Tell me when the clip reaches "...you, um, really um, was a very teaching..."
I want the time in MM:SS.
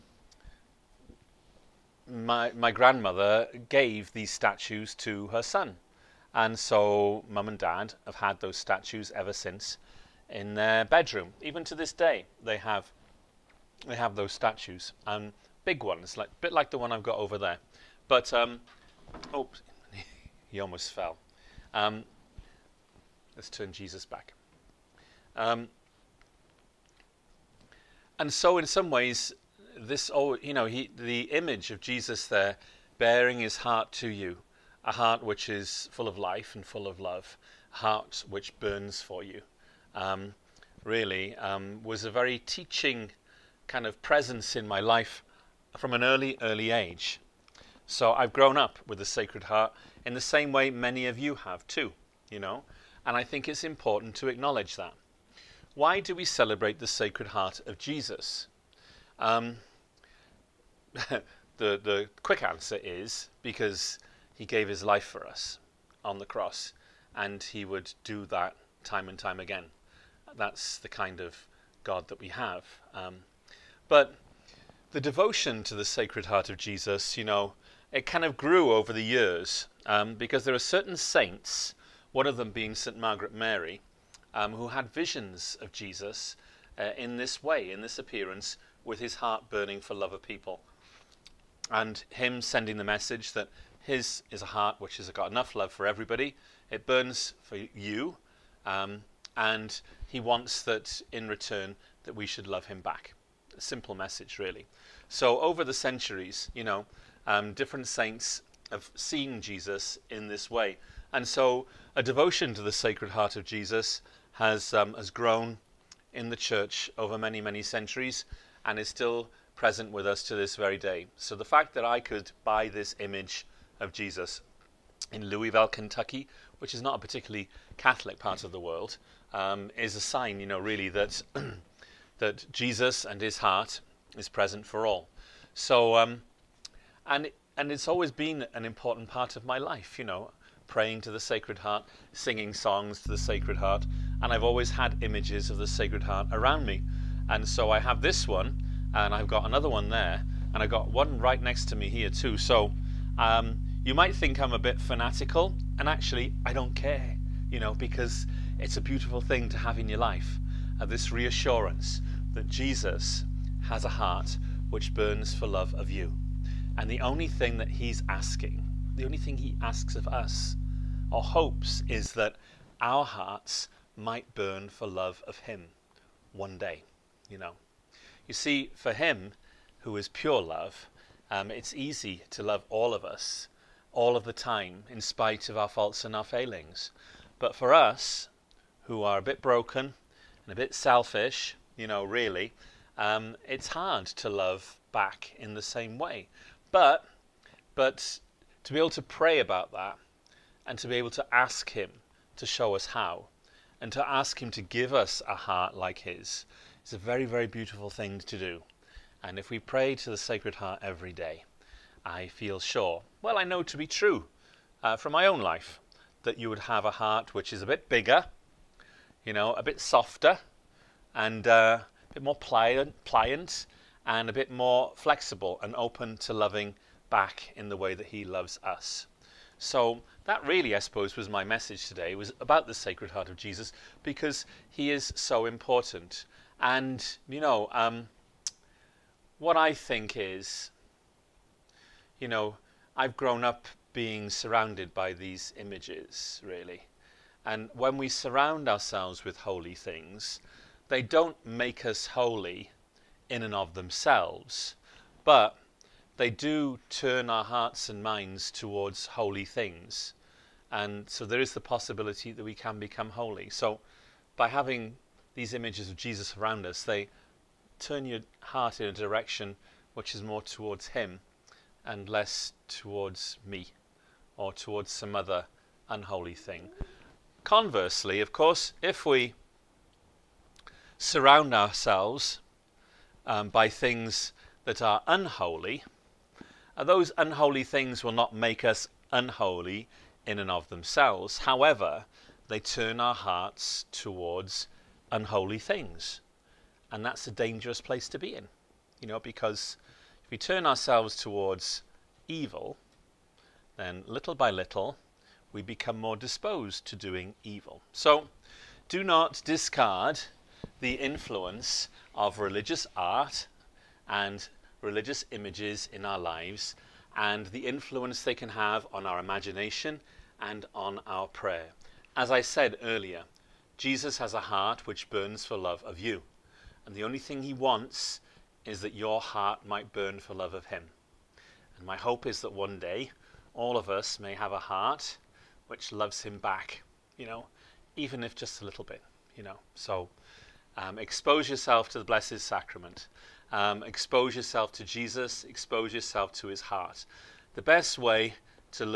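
00:39.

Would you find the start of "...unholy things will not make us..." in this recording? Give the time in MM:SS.
04:47.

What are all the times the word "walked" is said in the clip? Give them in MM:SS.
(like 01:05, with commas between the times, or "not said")
not said.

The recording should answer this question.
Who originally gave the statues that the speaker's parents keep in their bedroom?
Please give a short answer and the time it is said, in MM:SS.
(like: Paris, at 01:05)
grandmother, at 00:02.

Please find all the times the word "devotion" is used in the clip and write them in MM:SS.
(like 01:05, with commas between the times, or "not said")
01:15, 01:52.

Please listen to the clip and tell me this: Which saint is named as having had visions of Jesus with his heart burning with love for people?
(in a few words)
St. Margaret Mary.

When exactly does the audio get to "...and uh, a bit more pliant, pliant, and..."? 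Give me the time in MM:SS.
03:41.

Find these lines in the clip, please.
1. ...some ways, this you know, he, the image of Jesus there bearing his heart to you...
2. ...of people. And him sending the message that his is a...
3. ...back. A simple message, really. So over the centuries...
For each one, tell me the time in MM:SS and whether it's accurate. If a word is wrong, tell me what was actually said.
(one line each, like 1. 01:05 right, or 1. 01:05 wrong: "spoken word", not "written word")
1. 00:28 right
2. 01:30 right
3. 01:42 right.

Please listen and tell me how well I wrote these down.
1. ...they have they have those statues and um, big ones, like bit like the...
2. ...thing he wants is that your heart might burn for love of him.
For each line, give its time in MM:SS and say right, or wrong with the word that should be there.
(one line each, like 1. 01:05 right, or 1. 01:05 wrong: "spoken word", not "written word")
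1. 00:12 right
2. 05:27 right.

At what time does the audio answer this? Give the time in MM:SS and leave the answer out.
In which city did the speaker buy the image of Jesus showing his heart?
02:05.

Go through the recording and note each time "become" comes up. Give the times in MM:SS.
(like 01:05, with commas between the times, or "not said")
04:22, 05:05.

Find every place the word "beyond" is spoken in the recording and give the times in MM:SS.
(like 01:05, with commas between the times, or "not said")
not said.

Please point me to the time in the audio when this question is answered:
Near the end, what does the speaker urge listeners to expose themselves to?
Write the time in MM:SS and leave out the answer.
05:42.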